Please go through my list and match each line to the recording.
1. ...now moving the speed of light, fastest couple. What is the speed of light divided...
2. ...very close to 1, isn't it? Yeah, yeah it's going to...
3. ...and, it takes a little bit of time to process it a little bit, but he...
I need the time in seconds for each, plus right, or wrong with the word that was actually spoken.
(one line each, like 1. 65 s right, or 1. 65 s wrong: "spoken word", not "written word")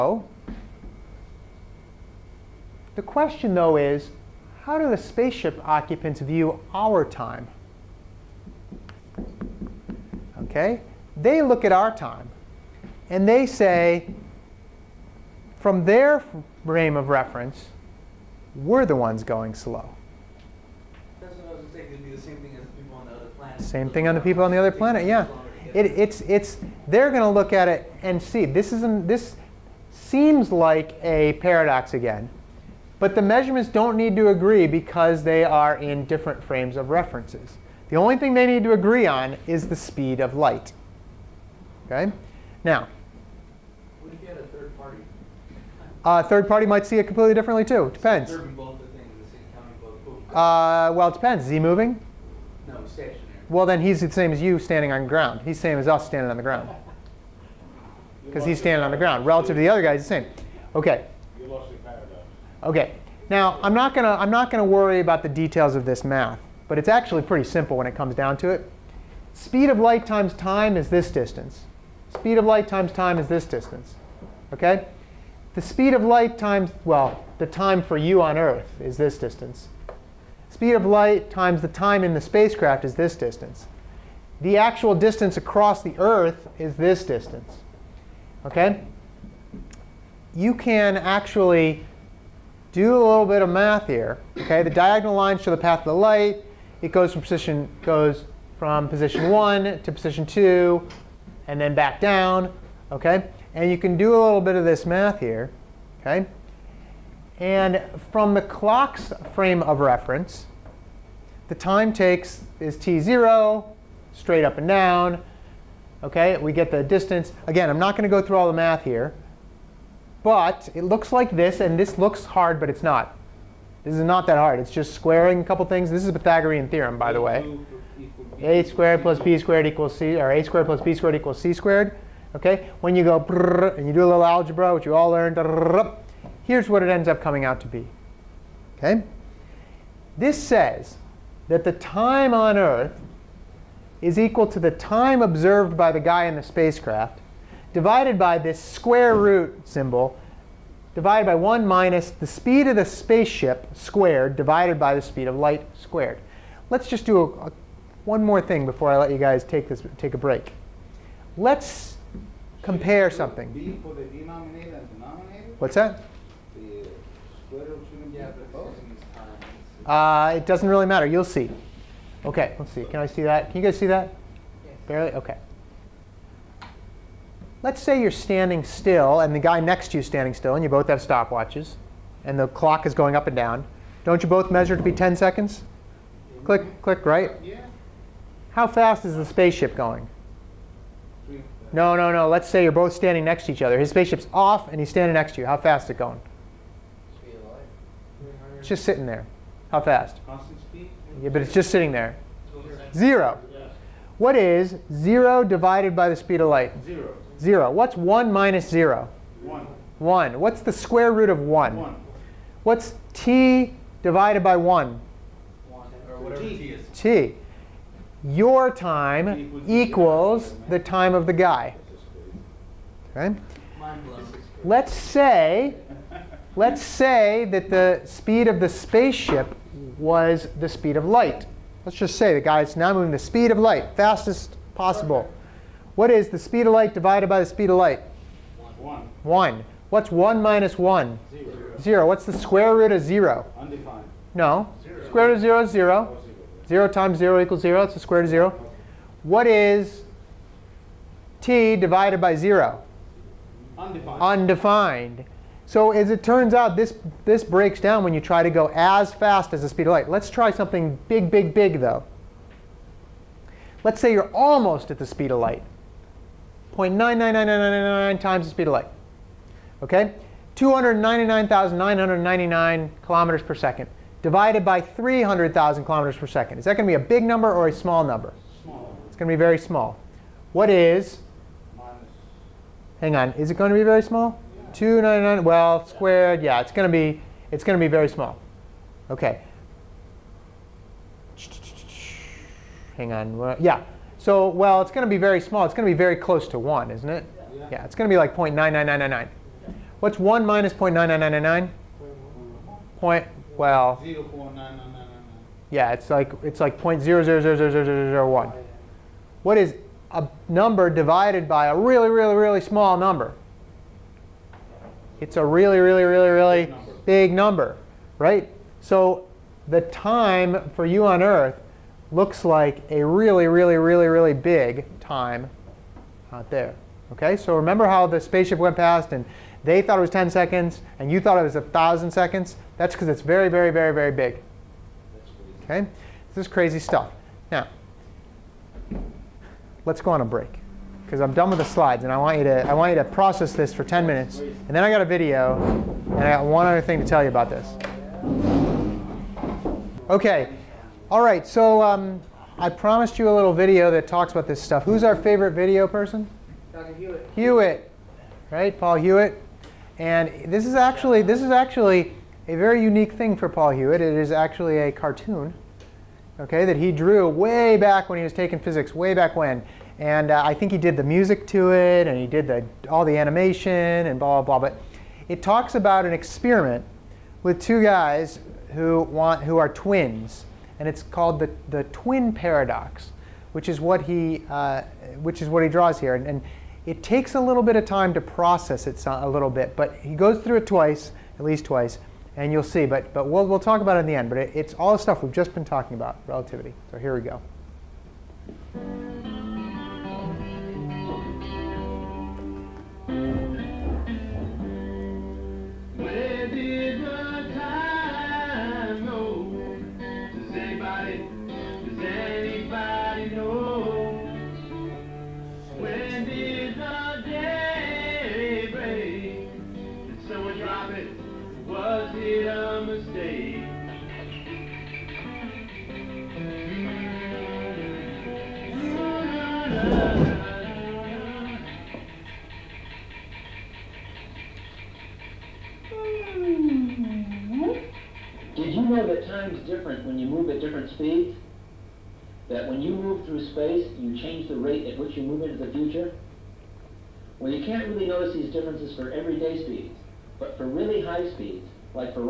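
1. 232 s wrong: "possible", not "couple"
2. 295 s right
3. 386 s right.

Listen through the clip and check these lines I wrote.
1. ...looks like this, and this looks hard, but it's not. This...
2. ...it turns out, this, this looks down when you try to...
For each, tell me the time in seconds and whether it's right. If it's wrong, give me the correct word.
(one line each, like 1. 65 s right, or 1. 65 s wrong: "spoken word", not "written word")
1. 120 s right
2. 256 s wrong: "breaks", not "looks".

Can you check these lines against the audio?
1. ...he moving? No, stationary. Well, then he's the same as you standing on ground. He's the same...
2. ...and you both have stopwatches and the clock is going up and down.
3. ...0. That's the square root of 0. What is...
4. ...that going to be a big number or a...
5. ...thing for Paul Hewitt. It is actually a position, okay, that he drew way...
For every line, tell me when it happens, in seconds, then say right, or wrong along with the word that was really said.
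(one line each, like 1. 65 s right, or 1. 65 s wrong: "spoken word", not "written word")
1. 51 s right
2. 180 s right
3. 247 s right
4. 276 s right
5. 363 s wrong: "cartoon", not "position".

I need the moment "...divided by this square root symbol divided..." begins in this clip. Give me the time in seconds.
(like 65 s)
147 s.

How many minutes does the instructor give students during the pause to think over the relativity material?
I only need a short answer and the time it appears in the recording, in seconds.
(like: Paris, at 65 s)
10 minutes, at 343 s.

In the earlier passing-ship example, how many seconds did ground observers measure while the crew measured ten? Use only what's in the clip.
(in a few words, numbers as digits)
1,000 seconds.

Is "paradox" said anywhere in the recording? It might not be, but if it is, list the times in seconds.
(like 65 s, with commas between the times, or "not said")
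31 s, 382 s.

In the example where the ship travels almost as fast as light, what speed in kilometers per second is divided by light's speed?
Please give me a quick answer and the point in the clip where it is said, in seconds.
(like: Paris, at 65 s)
299,999 kilometers per second, at 270 s.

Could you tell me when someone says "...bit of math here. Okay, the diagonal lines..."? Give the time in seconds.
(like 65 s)
93 s.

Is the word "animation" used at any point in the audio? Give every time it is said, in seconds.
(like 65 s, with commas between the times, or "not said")
373 s.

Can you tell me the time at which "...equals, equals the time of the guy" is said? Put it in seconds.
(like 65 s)
219 s.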